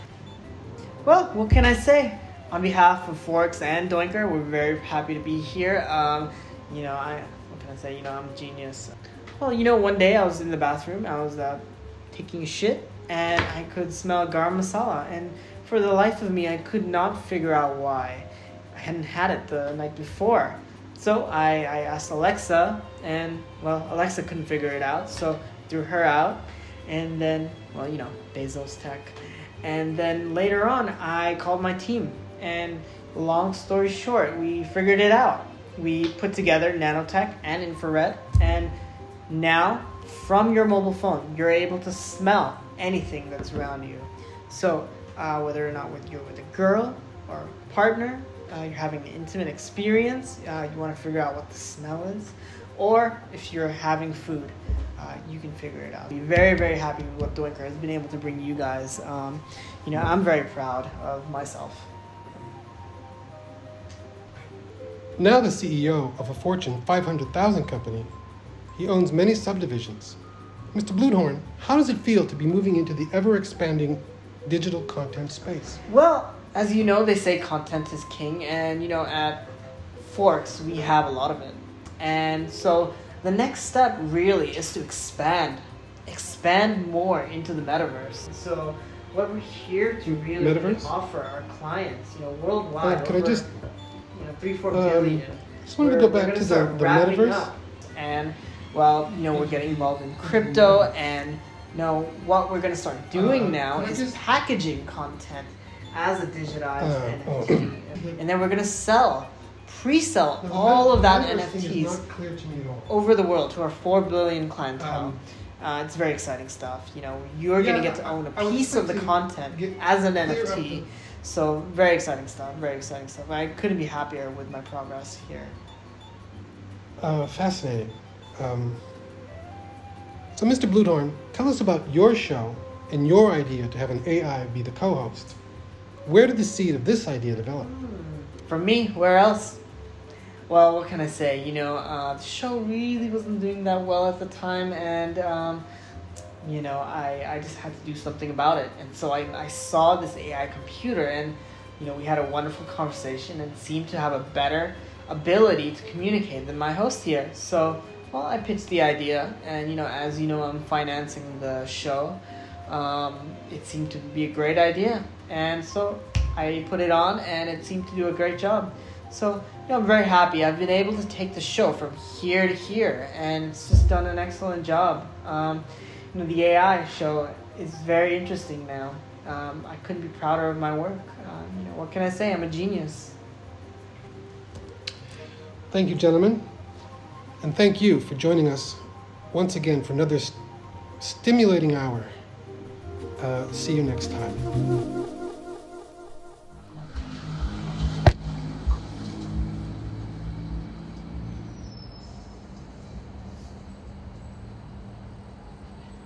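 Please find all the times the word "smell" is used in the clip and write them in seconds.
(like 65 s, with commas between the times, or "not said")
13 s, 41 s, 51 s.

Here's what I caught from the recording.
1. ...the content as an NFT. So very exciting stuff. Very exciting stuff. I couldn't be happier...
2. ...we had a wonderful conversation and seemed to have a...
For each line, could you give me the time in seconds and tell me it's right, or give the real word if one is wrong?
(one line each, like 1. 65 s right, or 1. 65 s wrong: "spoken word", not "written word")
1. 118 s right
2. 151 s right.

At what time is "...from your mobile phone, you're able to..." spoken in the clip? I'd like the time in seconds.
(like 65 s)
40 s.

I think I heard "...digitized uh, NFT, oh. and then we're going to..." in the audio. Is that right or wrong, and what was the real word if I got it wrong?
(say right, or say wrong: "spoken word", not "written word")
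right.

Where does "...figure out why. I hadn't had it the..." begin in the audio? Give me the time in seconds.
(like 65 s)
17 s.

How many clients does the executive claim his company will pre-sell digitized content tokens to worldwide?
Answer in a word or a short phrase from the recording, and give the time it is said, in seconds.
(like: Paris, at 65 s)
4 billion, at 113 s.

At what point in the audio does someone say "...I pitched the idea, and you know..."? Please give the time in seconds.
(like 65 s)
158 s.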